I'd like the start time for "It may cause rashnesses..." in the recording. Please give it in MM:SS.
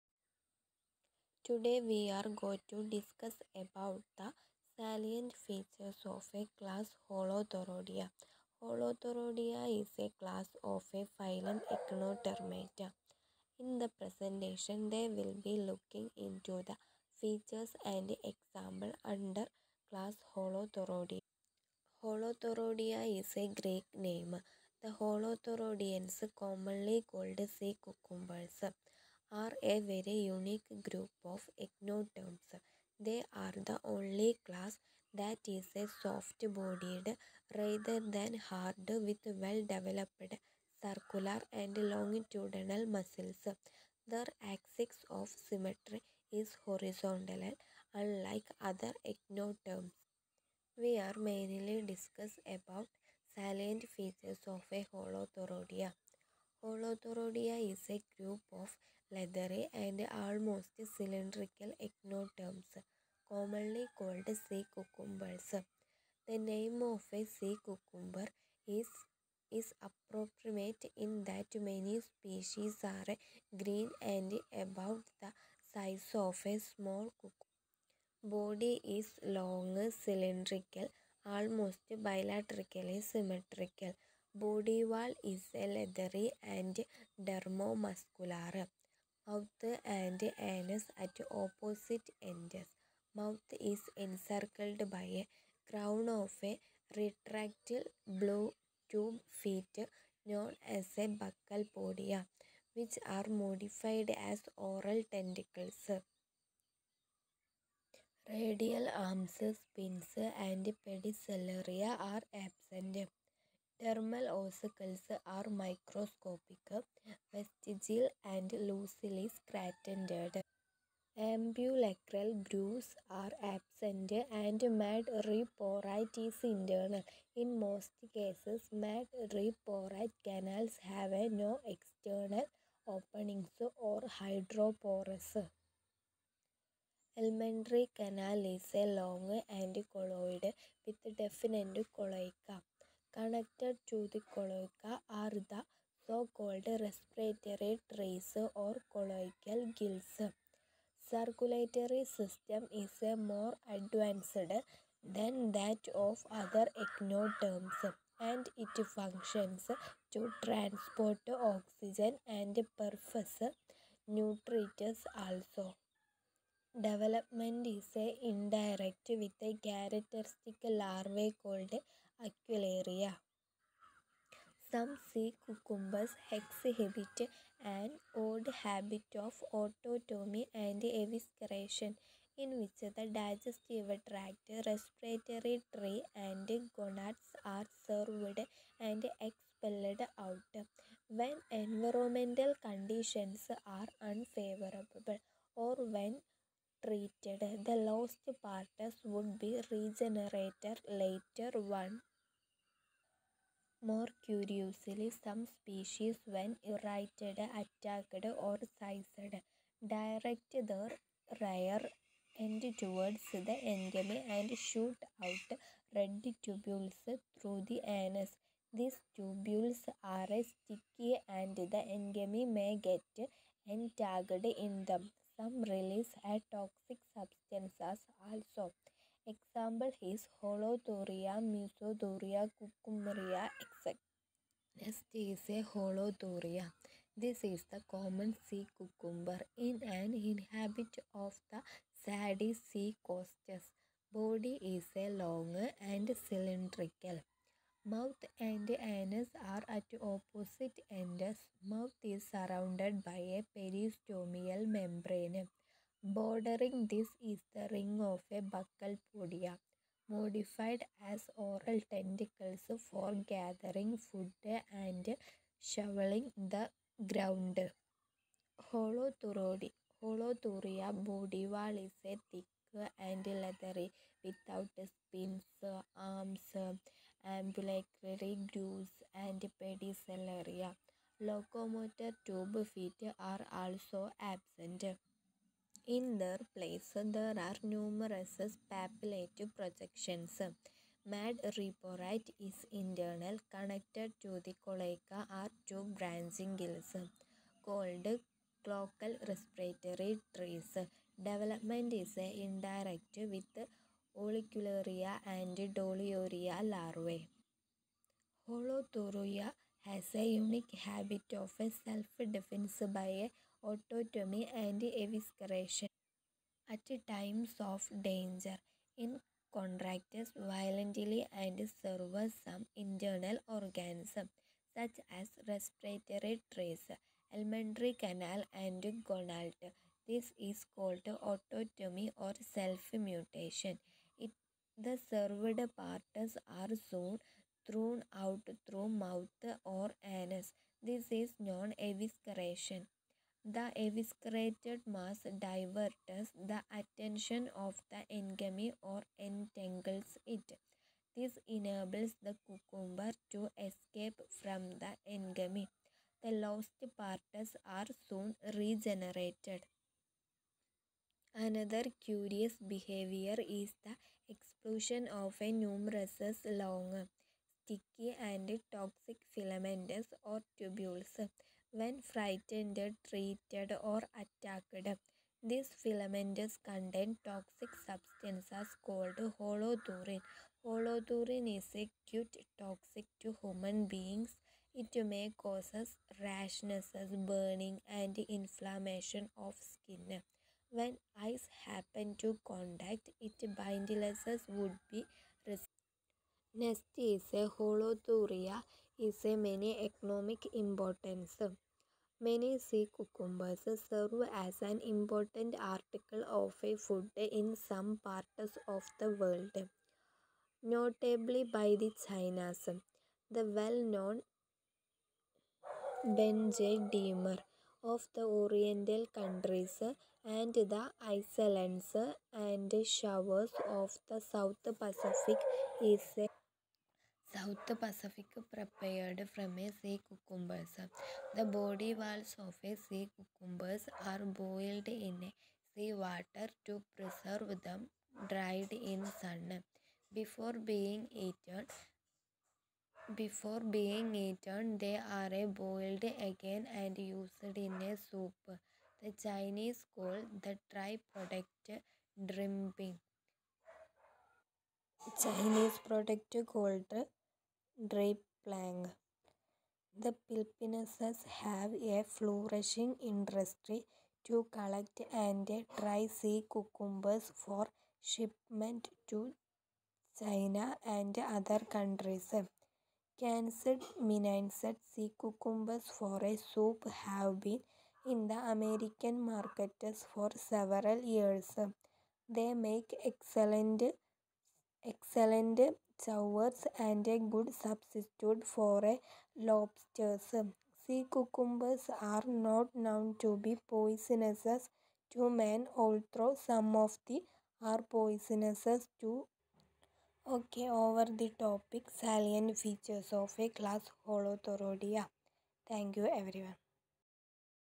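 06:24.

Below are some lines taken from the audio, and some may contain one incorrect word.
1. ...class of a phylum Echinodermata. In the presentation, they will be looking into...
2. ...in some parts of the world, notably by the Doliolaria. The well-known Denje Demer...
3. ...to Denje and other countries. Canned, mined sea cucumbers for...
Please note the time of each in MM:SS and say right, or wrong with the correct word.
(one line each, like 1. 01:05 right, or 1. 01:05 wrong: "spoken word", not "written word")
1. 00:10 right
2. 06:47 wrong: "Chinas", not "Doliolaria"
3. 07:49 wrong: "China", not "Denje".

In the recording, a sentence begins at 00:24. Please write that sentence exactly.
The Holothuroidians commonly called sea cucumbers are a very unique group of echinoderms.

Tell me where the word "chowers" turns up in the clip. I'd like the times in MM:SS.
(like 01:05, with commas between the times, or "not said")
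08:06.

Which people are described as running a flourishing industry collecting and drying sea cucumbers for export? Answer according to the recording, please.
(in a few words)
Filipinos.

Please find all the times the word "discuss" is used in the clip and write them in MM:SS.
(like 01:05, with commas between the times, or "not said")
00:02, 00:51.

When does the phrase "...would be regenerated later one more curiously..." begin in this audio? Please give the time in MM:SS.
03:19.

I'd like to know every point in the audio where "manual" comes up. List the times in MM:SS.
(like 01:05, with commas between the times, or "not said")
not said.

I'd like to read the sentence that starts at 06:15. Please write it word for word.
This filaments contain toxic substances called holothurin.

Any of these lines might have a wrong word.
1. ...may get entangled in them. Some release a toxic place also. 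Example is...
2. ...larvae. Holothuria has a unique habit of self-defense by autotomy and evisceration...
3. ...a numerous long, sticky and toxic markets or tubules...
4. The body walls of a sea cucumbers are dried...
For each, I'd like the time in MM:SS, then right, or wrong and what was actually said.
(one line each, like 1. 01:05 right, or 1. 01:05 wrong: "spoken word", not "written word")
1. 03:42 wrong: "substance", not "place"
2. 05:06 right
3. 06:05 wrong: "filaments", not "markets"
4. 07:11 wrong: "boiled", not "dried".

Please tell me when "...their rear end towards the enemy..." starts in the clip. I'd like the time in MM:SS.
03:30.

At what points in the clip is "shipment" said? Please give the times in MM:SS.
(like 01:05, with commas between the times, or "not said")
07:48.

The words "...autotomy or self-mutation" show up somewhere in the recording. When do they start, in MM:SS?
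05:31.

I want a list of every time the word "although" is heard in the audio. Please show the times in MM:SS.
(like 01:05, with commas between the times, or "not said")
08:15.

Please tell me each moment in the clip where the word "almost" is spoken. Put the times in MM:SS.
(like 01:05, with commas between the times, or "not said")
01:00, 01:21.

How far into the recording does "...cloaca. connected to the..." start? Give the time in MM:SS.
02:21.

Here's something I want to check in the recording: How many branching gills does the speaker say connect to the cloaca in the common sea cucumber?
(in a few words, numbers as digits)
2.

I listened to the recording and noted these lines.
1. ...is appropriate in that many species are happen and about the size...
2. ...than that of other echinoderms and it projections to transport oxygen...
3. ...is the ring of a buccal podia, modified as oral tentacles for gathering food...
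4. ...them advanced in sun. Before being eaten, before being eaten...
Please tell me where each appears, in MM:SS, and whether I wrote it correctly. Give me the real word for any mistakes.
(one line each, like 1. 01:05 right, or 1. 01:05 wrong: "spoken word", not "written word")
1. 01:09 wrong: "green", not "happen"
2. 02:35 wrong: "functions", not "projections"
3. 04:17 right
4. 07:17 wrong: "dried", not "advanced".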